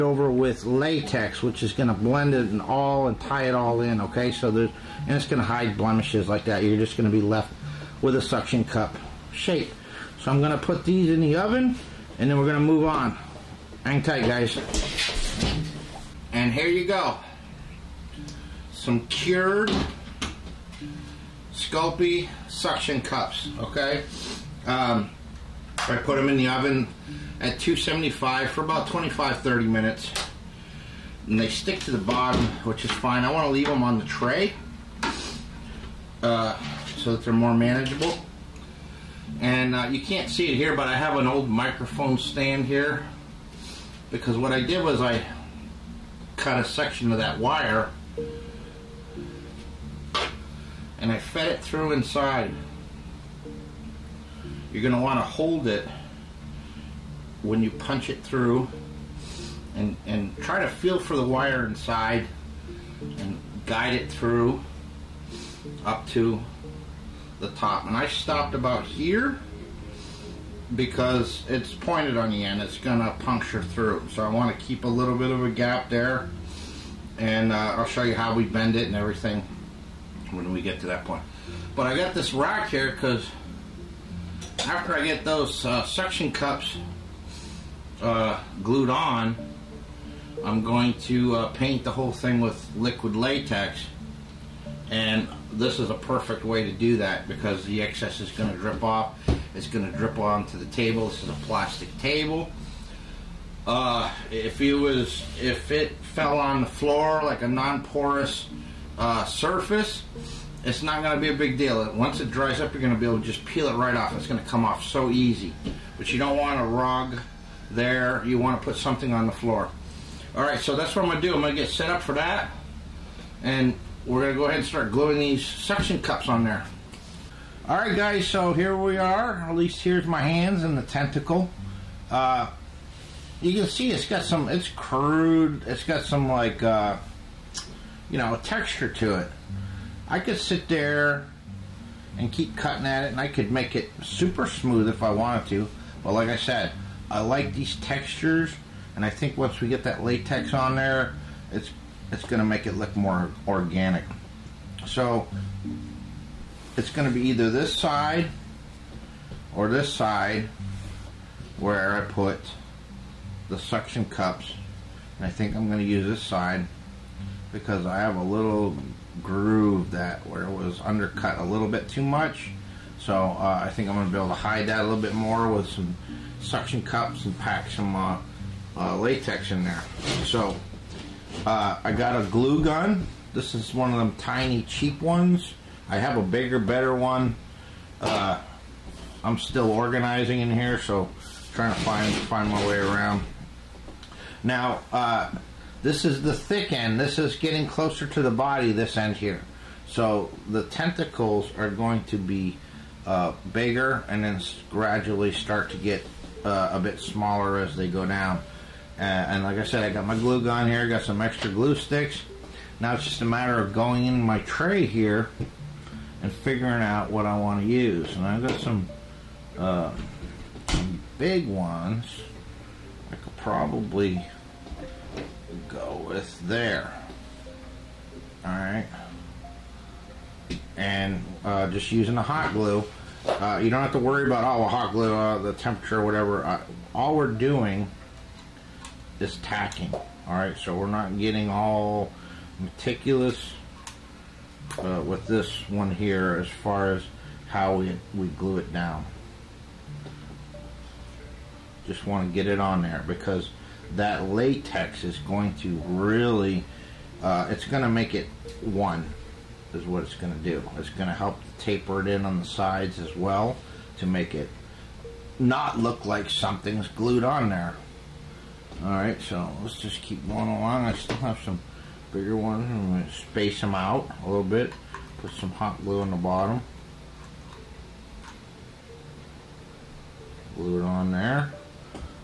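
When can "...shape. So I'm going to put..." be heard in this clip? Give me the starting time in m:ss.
0:09.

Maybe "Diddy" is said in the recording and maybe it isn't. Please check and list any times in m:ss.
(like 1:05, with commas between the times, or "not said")
not said.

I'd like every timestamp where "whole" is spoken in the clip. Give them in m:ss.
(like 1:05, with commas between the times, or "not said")
1:31.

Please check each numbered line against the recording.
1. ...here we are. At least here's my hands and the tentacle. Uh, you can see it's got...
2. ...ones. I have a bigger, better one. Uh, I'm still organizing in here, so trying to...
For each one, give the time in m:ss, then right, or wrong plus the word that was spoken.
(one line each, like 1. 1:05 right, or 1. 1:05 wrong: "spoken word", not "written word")
1. 2:08 right
2. 3:05 right.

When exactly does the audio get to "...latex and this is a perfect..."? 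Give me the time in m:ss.
1:33.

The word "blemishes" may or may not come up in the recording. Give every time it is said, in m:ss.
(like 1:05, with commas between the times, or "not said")
0:05.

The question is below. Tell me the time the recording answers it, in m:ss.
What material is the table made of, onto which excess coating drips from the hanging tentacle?
1:41.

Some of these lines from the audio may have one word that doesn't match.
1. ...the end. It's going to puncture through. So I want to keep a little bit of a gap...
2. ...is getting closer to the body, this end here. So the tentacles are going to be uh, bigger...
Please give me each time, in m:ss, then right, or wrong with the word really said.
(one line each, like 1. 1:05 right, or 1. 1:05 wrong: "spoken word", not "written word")
1. 1:12 right
2. 3:17 right.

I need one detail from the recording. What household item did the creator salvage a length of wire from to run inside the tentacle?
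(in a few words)
Microphone stand.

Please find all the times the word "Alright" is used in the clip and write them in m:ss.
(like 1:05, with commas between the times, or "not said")
3:48, 4:00, 4:28.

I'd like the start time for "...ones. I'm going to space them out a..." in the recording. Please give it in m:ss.
4:32.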